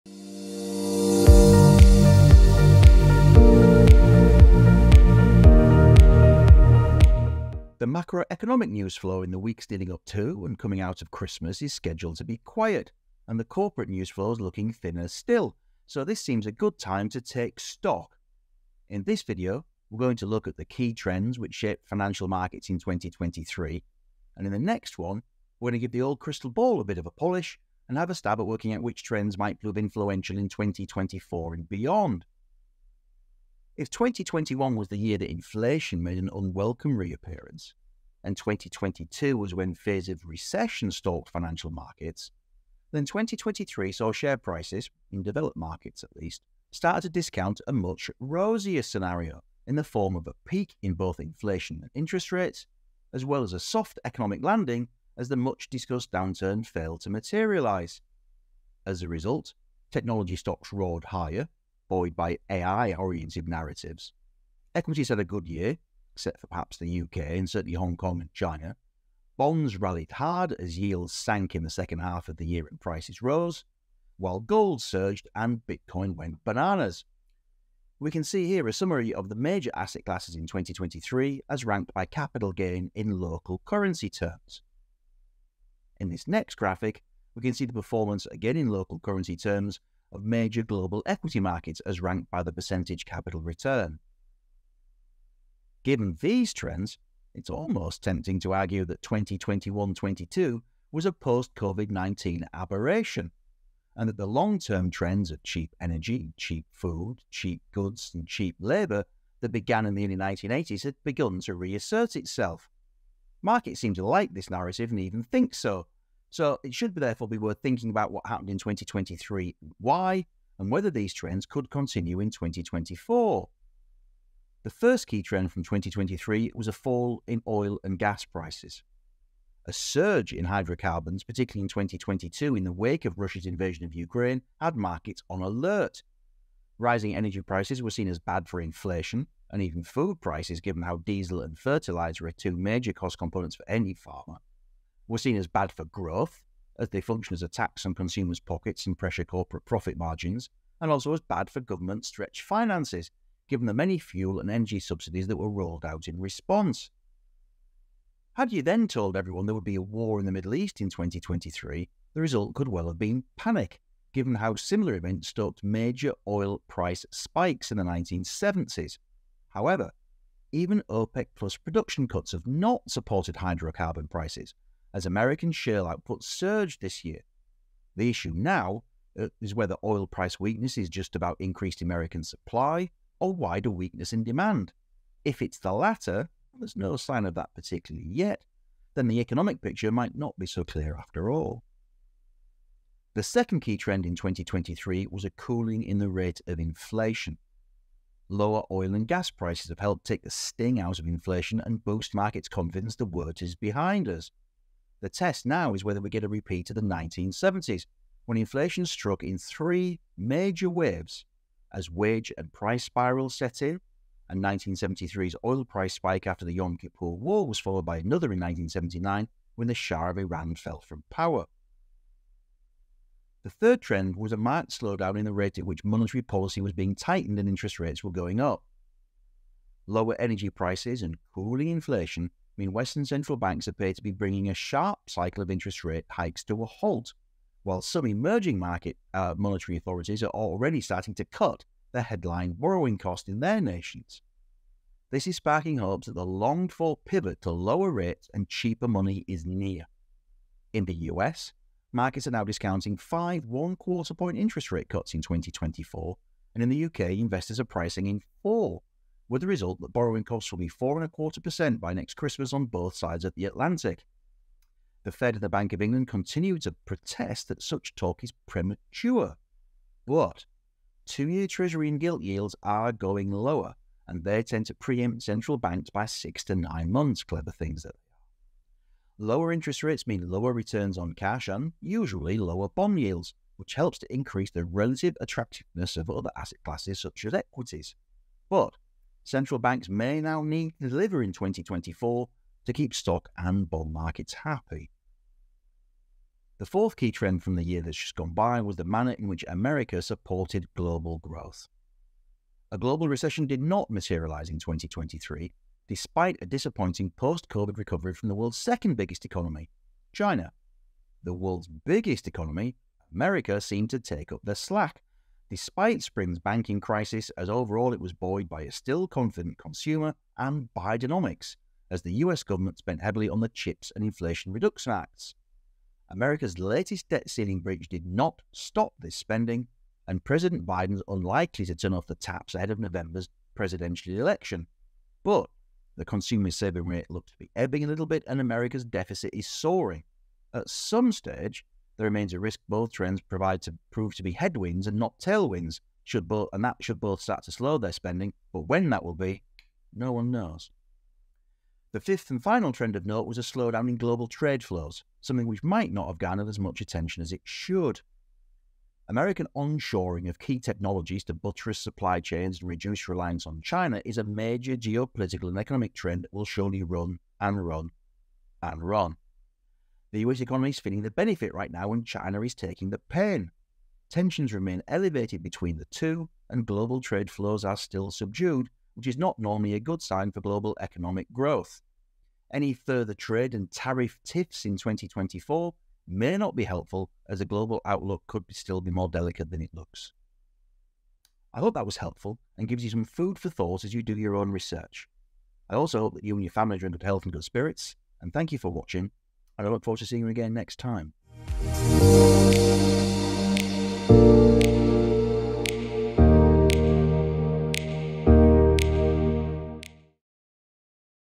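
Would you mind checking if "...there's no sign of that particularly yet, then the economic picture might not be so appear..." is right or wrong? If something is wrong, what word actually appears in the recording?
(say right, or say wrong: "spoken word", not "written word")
wrong: "clear", not "appear".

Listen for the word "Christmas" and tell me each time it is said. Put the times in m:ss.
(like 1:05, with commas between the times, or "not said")
0:11, 4:22.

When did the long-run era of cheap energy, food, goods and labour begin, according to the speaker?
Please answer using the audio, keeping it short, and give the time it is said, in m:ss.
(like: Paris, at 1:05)
early 1980s, at 1:50.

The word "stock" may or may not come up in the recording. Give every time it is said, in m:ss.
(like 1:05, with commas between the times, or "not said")
0:17, 1:00, 4:52.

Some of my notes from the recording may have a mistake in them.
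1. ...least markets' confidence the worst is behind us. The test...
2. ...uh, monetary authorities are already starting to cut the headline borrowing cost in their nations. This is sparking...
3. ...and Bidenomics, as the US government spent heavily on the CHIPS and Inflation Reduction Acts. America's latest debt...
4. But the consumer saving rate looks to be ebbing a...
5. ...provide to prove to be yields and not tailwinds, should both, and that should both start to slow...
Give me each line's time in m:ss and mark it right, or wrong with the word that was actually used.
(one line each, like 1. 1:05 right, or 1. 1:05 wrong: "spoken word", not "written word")
1. 3:21 wrong: "boost", not "least"
2. 3:59 right
3. 5:20 right
4. 5:35 right
5. 5:43 wrong: "headwinds", not "yields".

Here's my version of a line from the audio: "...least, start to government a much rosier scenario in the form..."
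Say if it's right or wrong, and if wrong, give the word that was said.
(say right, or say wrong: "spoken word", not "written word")
wrong: "discount", not "government".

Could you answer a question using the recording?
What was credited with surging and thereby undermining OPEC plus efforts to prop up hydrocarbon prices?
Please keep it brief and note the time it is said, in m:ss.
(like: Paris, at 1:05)
American shale output, at 2:55.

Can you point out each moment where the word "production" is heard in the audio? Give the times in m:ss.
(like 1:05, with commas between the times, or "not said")
2:51.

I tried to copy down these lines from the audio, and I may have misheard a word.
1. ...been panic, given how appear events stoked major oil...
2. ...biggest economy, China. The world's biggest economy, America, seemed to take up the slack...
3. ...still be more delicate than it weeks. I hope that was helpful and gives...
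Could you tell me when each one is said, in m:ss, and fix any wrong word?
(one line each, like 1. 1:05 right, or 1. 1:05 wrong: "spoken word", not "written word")
1. 2:42 wrong: "similar", not "appear"
2. 5:08 right
3. 6:28 wrong: "looks", not "weeks".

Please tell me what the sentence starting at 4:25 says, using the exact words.
The Fed and the Bank of England continue to protest that such talk is premature.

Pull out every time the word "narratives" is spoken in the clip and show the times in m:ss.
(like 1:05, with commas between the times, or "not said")
1:03, 1:54.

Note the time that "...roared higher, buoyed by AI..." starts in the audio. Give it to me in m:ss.
1:00.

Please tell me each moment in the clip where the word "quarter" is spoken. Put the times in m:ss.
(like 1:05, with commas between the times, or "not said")
4:13, 4:21.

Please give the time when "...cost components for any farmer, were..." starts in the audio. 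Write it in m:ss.
2:22.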